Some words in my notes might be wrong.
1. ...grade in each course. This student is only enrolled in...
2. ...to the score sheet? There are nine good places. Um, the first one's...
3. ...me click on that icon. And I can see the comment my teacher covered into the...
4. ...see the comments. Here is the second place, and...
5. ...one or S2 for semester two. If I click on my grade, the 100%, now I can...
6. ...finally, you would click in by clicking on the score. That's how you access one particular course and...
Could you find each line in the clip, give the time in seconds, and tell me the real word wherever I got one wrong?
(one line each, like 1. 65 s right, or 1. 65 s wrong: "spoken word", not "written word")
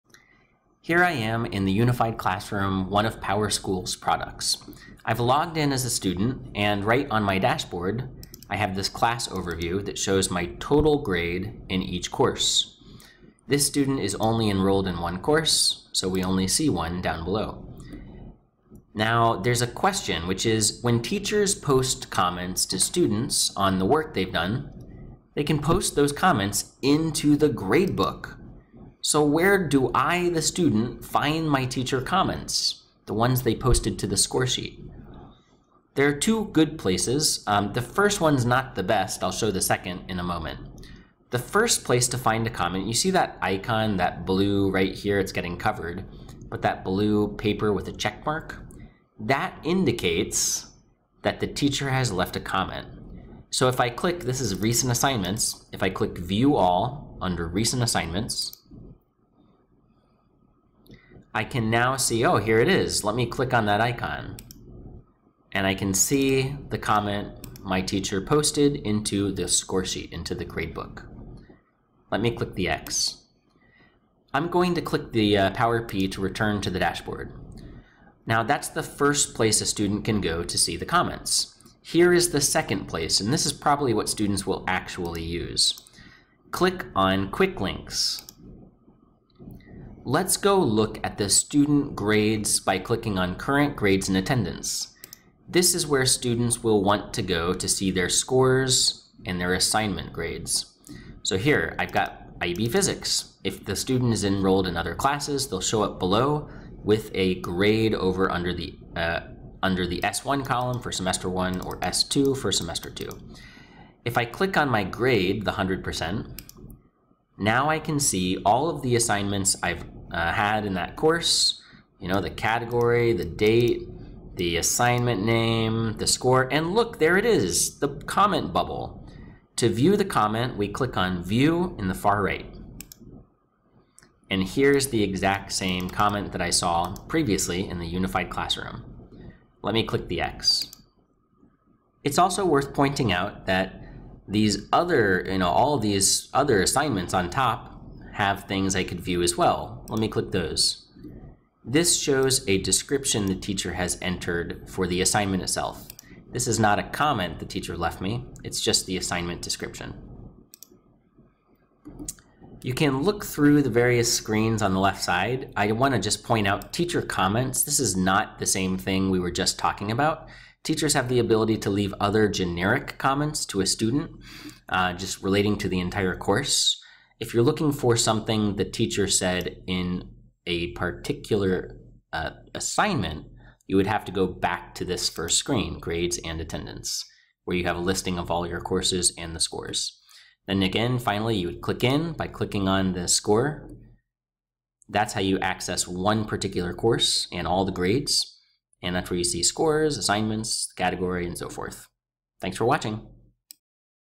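1. 11 s right
2. 33 s wrong: "two", not "nine"
3. 63 s wrong: "posted", not "covered"
4. 80 s right
5. 111 s right
6. 190 s right.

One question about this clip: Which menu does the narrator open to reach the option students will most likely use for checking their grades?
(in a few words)
Quick links.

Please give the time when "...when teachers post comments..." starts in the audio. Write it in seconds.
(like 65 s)
20 s.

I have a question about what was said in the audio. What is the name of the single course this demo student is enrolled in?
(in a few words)
IB Physics.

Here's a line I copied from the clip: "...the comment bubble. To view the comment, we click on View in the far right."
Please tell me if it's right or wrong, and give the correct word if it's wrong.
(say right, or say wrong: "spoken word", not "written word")
right.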